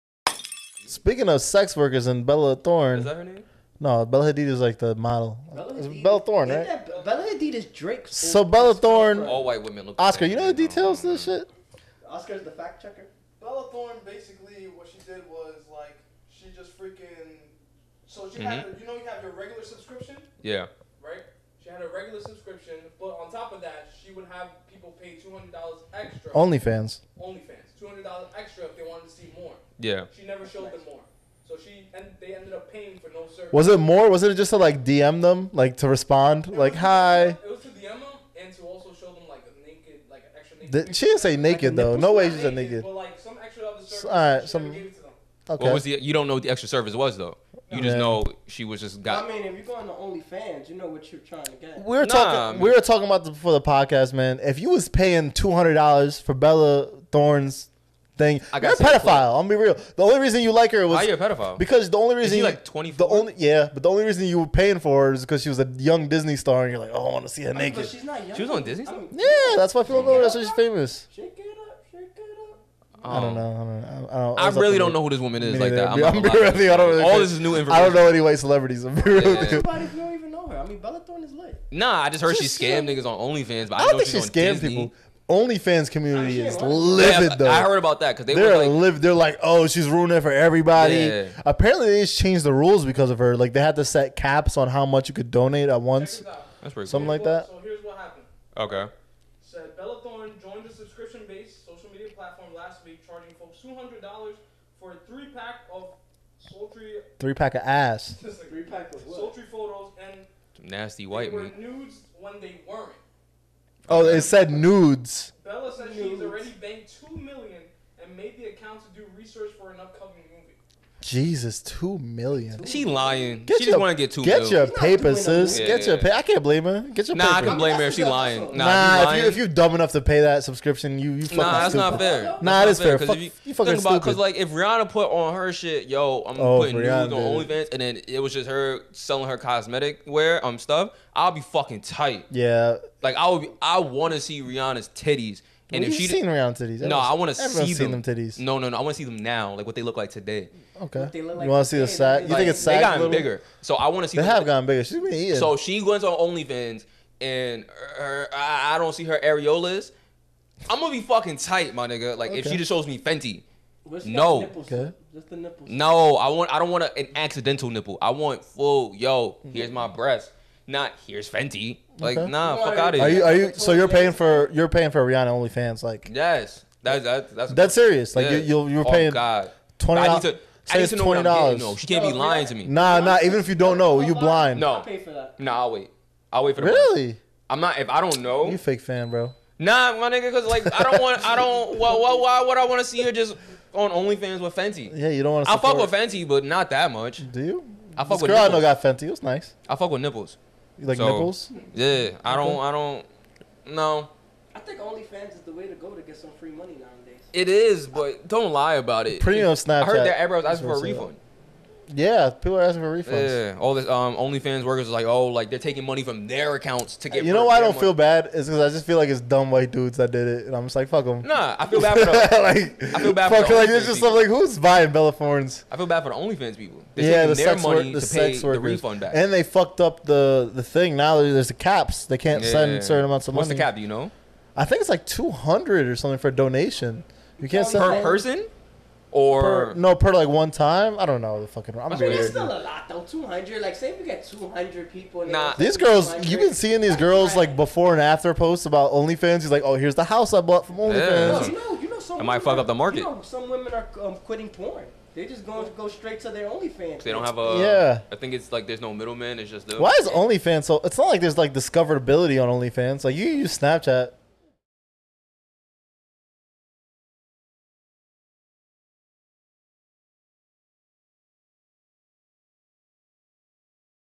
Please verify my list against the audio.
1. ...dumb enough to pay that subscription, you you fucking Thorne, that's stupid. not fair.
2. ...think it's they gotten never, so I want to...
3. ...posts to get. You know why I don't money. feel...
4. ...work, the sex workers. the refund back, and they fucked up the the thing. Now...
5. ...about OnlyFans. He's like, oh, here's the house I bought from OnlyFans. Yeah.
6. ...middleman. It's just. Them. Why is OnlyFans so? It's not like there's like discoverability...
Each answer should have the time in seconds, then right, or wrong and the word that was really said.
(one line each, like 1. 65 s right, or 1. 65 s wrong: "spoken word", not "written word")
1. 129 s wrong: "Nah", not "Thorne"
2. 152 s wrong: "bigger", not "never"
3. 216 s wrong: "accounts", not "posts"
4. 227 s right
5. 248 s right
6. 258 s right.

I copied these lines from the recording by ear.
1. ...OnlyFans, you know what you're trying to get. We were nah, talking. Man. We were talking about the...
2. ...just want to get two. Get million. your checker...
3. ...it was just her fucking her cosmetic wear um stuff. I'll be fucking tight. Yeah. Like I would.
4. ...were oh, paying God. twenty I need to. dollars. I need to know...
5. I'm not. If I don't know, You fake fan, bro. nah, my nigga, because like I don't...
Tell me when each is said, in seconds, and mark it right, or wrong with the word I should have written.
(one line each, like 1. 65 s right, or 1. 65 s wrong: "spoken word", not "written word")
1. 49 s right
2. 123 s wrong: "paper", not "checker"
3. 138 s wrong: "selling", not "fucking"
4. 178 s right
5. 187 s right.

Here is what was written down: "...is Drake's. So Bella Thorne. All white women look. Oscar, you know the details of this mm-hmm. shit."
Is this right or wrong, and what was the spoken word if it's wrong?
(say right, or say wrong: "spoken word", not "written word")
right.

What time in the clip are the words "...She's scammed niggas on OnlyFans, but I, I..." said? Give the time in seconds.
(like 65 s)
82 s.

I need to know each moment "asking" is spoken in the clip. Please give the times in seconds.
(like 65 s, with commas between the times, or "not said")
212 s.